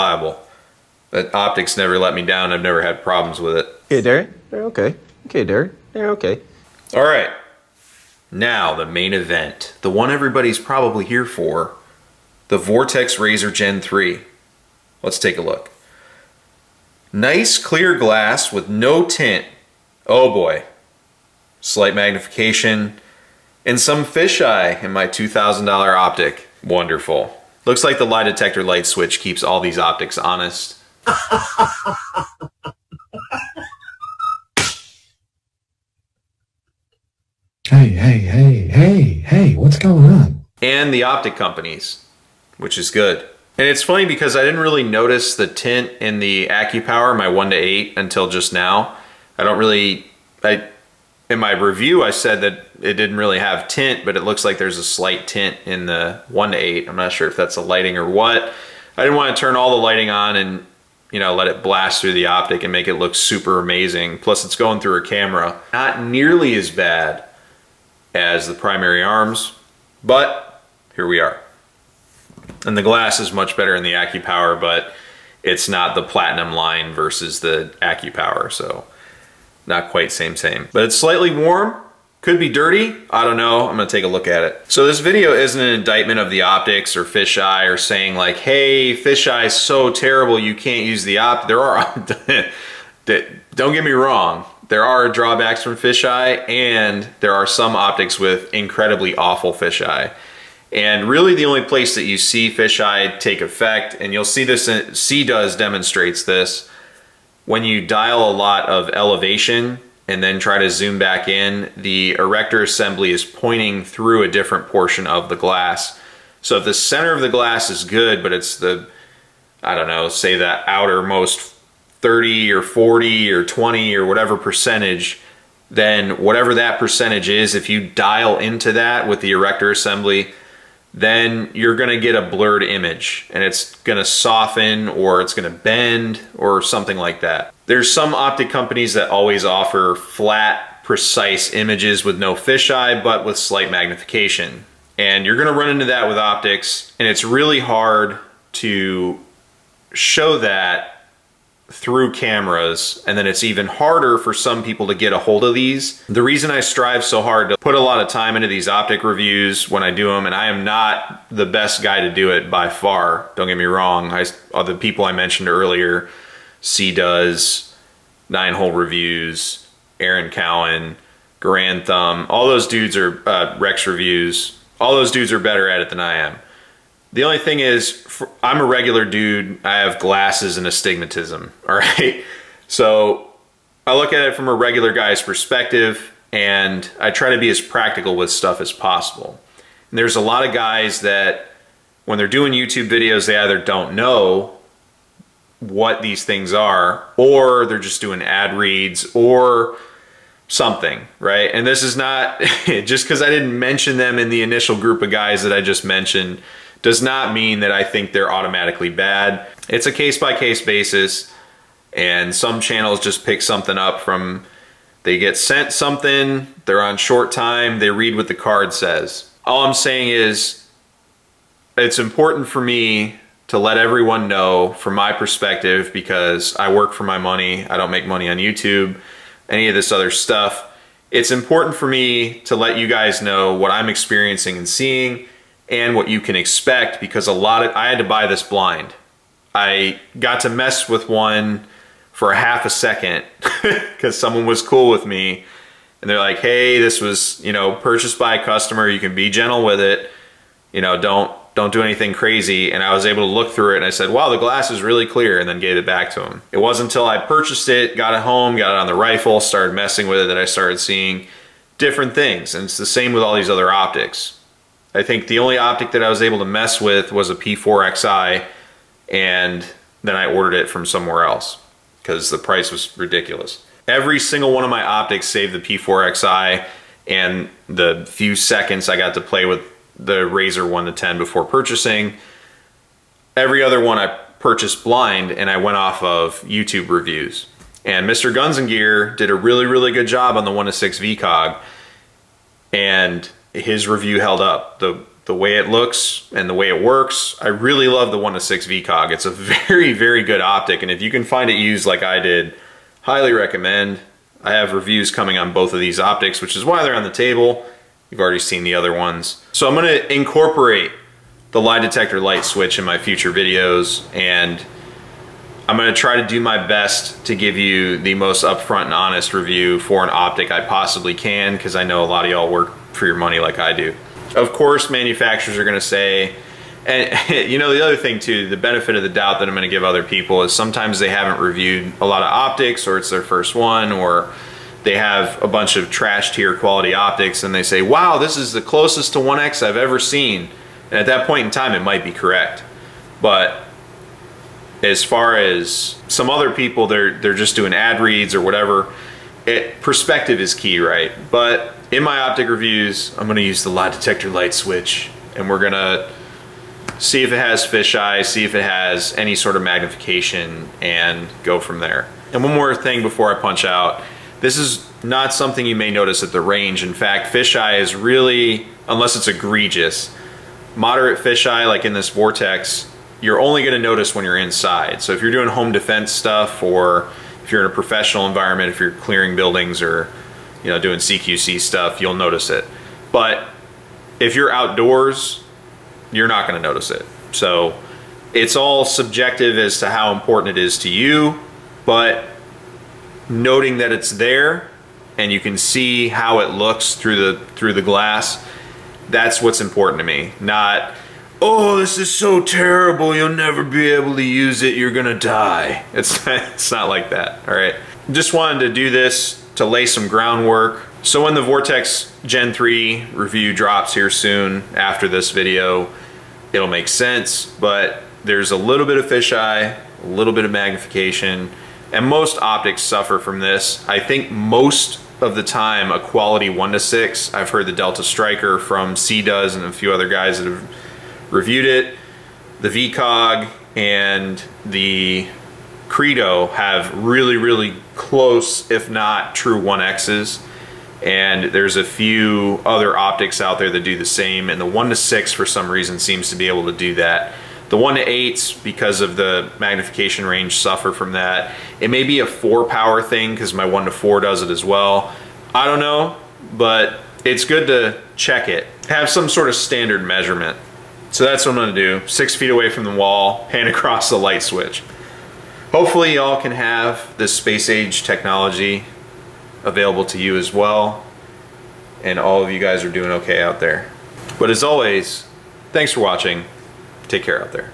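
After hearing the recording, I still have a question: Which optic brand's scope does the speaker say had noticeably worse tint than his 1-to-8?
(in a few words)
Primary Arms.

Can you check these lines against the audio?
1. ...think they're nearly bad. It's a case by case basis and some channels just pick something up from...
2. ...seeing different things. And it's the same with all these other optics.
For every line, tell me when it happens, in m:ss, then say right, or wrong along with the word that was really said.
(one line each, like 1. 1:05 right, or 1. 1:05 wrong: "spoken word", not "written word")
1. 3:27 wrong: "automatically", not "nearly"
2. 4:20 right.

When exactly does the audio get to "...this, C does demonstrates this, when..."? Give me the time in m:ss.
1:44.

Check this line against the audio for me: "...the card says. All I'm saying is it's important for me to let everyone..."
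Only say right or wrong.
right.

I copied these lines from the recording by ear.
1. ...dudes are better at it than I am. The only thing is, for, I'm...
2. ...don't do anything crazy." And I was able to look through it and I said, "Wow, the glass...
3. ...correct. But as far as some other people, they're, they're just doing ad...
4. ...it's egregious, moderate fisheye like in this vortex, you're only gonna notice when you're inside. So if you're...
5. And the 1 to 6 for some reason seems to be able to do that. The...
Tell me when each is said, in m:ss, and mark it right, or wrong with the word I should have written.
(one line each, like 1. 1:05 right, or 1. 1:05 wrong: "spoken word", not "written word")
1. 2:55 right
2. 4:11 right
3. 5:42 right
4. 6:09 right
5. 7:24 right.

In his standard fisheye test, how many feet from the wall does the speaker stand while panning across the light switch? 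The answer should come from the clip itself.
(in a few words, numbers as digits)
6.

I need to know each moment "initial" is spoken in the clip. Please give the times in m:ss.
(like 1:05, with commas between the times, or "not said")
3:24.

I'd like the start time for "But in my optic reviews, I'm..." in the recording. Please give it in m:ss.
5:51.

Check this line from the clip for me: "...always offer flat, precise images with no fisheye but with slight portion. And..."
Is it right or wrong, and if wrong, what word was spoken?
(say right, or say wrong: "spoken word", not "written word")
wrong: "magnification", not "portion".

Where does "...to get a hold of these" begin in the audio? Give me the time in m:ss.
2:34.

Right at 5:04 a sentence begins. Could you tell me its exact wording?
I have reviews coming on both of these optics, which is why they're on the table.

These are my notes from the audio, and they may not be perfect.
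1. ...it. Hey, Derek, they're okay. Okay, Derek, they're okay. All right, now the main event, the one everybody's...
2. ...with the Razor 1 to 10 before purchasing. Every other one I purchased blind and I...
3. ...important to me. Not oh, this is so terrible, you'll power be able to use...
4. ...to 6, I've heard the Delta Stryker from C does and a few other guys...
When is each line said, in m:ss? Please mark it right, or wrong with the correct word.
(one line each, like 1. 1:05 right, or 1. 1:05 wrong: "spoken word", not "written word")
1. 0:03 right
2. 4:39 right
3. 6:39 wrong: "never", not "power"
4. 7:06 right.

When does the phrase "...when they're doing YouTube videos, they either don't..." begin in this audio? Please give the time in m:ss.
3:12.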